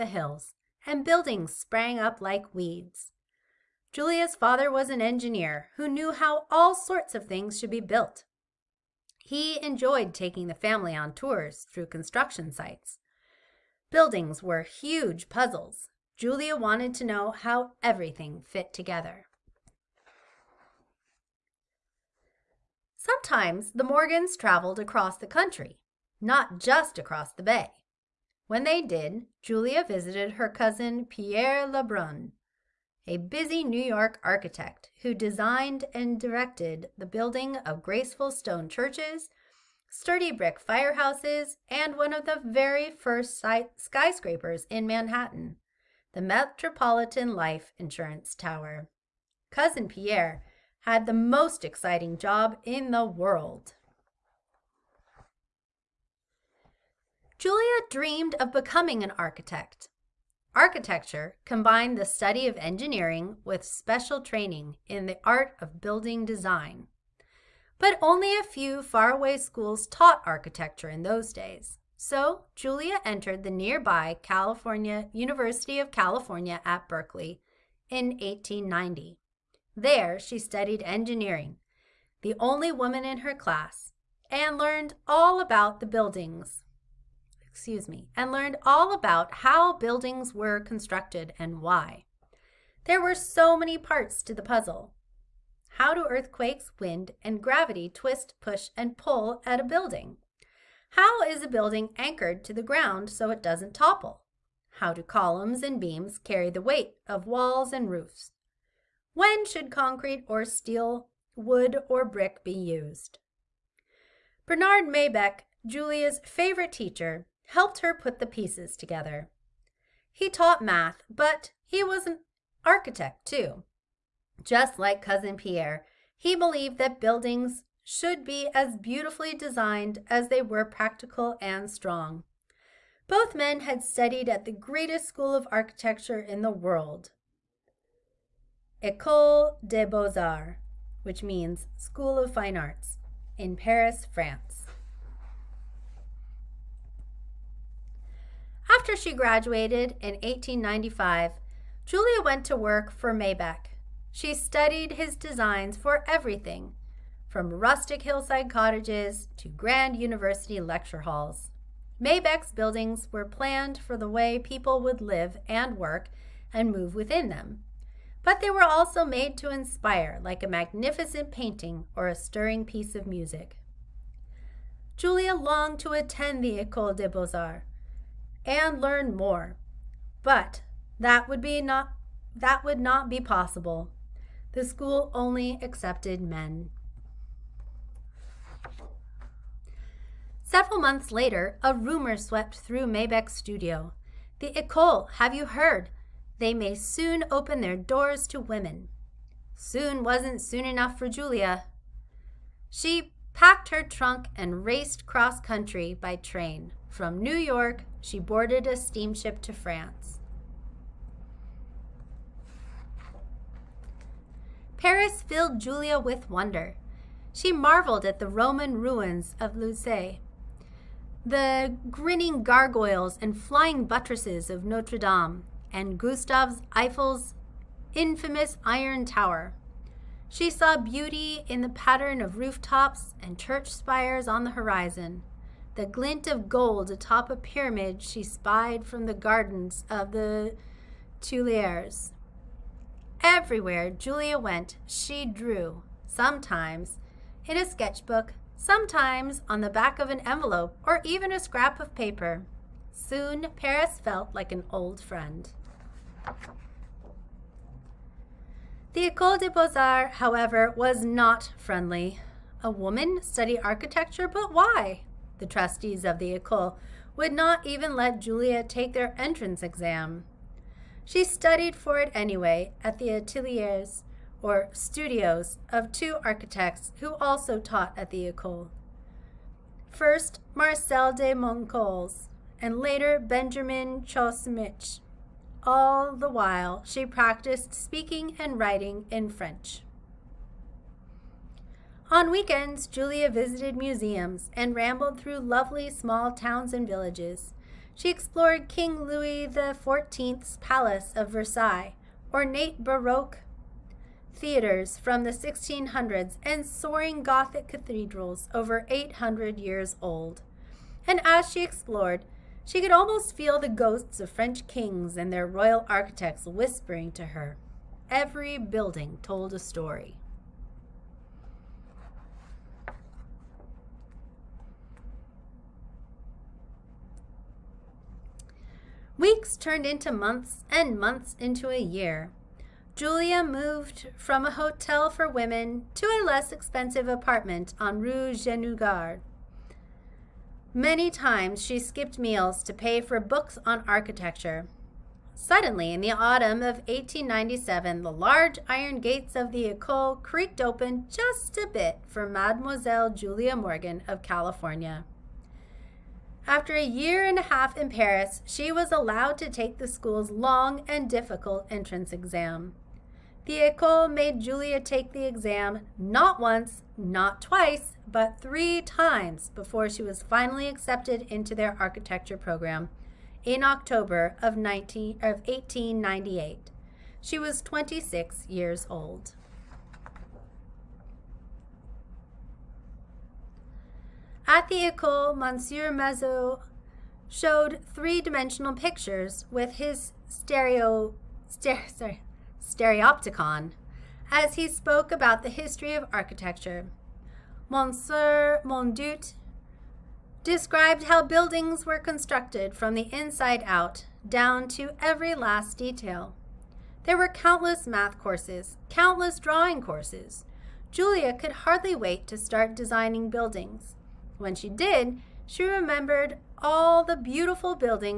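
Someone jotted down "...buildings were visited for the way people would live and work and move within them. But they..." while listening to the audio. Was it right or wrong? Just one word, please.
wrong.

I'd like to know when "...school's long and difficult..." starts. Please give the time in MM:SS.
05:59.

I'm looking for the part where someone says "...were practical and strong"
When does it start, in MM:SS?
02:10.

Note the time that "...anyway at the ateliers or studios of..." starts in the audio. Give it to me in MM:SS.
04:32.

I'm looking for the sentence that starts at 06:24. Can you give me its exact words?
At the Ecole, Monsieur Mazot showed three-dimensional pictures with his stereo, sorry, stereopticon as he spoke about the history of architecture.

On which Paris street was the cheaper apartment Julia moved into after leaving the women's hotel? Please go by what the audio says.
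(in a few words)
Rue Guénégaud.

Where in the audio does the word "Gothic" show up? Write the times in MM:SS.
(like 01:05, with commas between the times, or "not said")
05:07.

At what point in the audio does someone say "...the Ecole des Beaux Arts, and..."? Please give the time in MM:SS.
02:56.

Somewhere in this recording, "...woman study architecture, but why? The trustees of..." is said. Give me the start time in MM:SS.
04:22.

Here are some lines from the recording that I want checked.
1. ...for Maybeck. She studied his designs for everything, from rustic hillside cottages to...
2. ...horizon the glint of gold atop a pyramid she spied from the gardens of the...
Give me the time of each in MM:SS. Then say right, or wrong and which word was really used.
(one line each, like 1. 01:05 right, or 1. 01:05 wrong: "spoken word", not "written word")
1. 02:32 right
2. 03:54 right.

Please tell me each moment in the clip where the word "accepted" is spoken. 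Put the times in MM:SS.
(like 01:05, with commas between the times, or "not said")
03:05, 06:10.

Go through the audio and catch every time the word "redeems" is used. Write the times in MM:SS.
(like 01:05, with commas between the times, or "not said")
not said.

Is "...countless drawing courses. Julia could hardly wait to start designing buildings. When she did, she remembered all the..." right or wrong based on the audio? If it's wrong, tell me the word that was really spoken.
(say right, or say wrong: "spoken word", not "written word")
right.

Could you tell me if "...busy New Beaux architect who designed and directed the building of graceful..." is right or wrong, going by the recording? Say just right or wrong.
wrong.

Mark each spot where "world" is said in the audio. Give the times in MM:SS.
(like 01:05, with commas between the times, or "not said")
00:53, 02:16.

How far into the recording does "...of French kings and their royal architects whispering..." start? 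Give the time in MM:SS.
05:14.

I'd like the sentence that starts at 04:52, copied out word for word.
On weekends, Julia visited museums and rambled through lovely small towns and villages.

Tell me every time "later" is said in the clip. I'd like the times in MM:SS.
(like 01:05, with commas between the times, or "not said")
03:11, 04:42.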